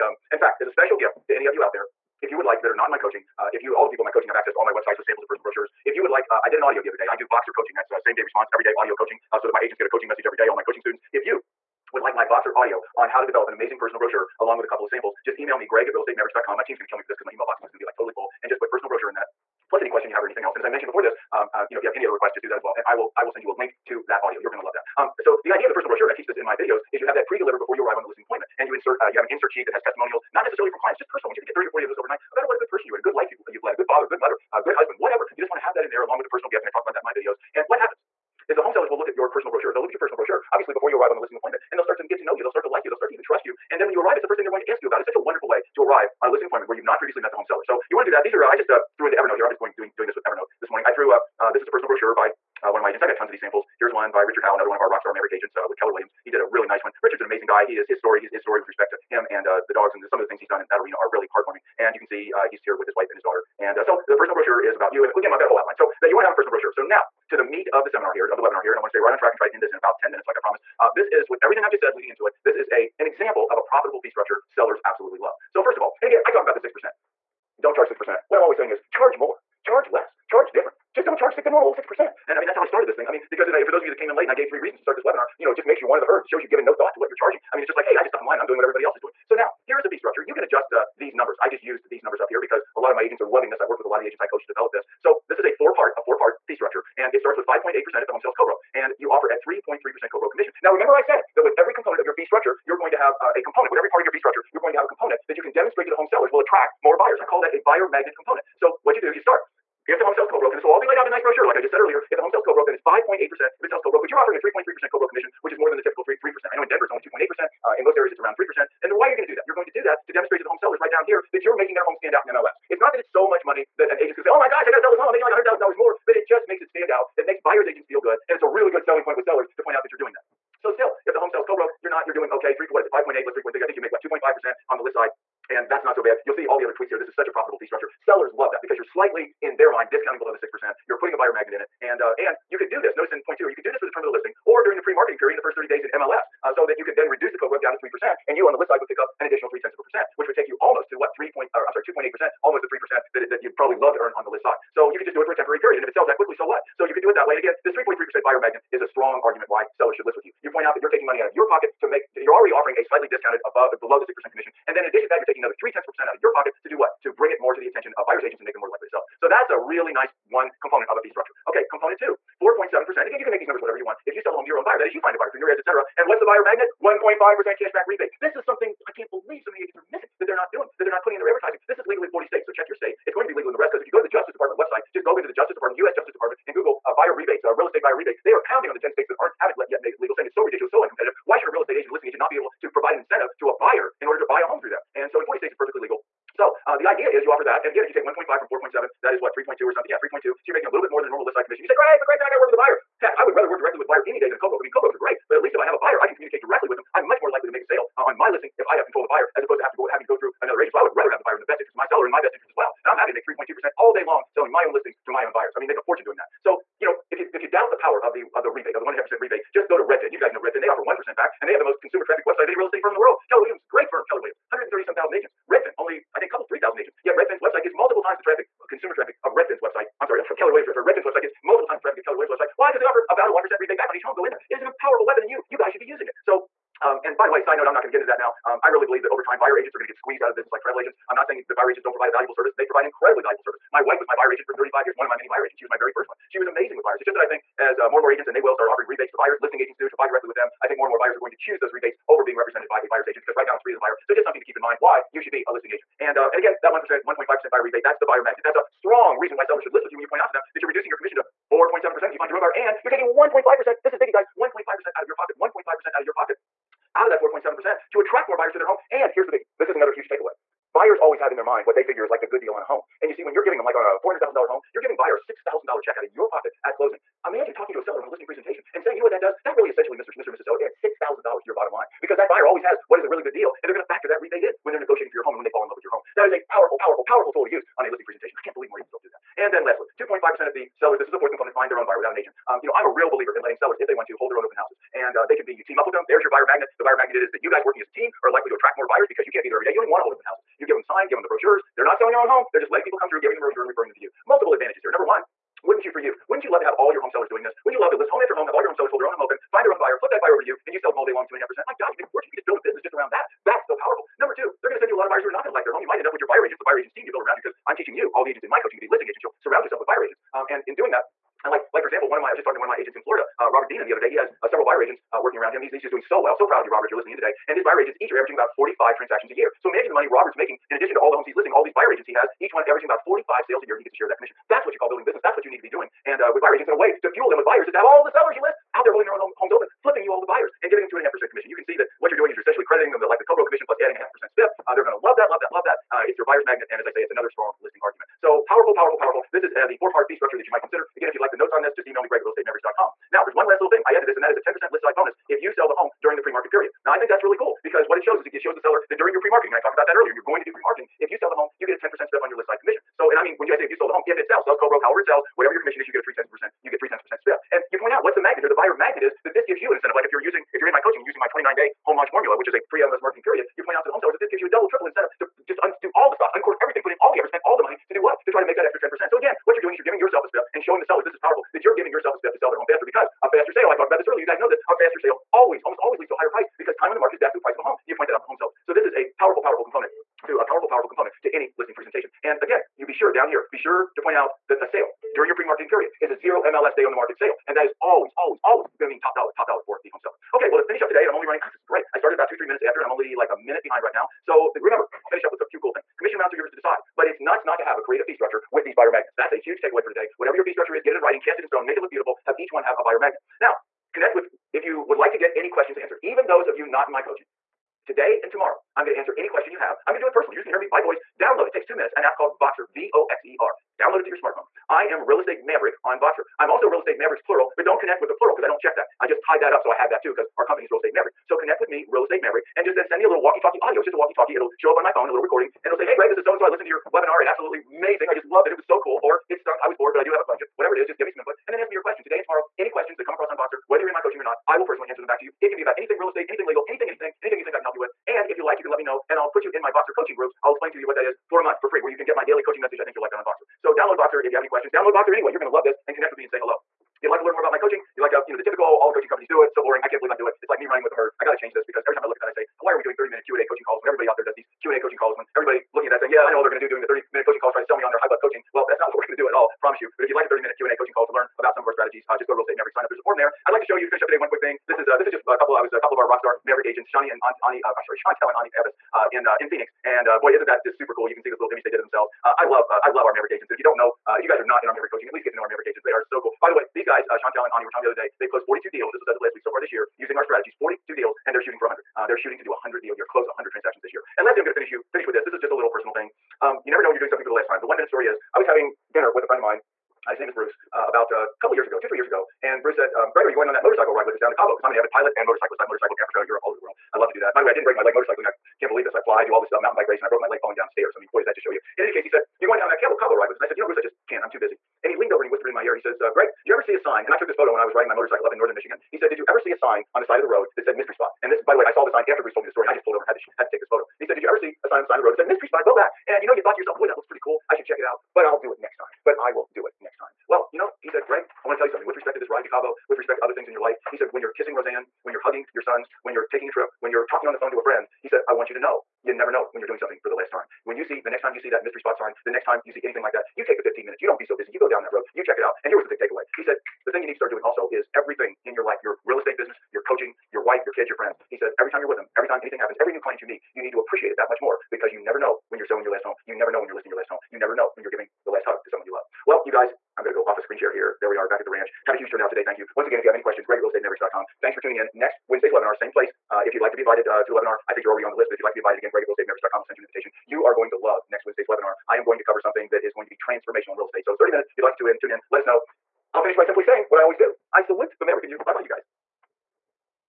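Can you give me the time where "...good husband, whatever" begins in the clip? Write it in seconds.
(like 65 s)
34 s.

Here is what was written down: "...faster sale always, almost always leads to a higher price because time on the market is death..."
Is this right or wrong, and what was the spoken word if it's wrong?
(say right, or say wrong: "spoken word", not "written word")
right.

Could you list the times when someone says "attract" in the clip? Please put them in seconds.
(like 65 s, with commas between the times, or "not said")
106 s, 267 s, 298 s.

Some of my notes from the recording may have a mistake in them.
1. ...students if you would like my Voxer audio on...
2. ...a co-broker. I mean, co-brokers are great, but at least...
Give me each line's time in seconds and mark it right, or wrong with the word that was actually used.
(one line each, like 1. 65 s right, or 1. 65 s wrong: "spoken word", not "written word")
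1. 10 s right
2. 204 s right.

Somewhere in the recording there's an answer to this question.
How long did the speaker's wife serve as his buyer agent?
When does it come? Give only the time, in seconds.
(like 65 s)
244 s.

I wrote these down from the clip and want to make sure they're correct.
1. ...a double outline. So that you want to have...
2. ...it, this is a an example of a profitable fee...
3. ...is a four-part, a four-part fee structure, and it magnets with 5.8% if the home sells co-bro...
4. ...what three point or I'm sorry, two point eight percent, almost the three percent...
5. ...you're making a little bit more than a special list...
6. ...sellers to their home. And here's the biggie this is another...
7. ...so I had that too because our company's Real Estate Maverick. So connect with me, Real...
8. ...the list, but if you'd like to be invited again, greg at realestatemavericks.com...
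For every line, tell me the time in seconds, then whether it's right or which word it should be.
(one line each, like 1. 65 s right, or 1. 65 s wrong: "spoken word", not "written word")
1. 65 s wrong: "whole", not "double"
2. 72 s right
3. 95 s wrong: "starts", not "magnets"
4. 150 s right
5. 200 s wrong: "normal", not "special"
6. 268 s wrong: "buyers", not "sellers"
7. 429 s right
8. 568 s right.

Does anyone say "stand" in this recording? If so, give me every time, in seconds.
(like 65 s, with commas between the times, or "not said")
121 s, 126 s.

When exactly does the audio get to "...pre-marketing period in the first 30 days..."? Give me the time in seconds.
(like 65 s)
144 s.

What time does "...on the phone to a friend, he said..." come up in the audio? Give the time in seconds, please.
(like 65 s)
537 s.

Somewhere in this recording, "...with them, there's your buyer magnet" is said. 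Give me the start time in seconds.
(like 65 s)
295 s.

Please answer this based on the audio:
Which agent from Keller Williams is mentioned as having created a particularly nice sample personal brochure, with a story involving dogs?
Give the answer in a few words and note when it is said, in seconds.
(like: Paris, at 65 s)
Richard Howe, at 54 s.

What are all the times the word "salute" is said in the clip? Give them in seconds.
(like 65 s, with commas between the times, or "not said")
577 s.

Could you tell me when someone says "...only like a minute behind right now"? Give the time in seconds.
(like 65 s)
402 s.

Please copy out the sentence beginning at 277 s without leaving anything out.
Imagine talking to a seller on a listing presentation and saying, you know what that does?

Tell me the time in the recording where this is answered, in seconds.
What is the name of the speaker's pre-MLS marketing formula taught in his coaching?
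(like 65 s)
371 s.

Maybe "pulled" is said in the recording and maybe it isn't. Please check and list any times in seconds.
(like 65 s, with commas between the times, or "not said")
522 s.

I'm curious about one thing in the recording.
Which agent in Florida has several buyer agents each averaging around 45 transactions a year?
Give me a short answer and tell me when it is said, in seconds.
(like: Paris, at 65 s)
Robert Deanan, at 323 s.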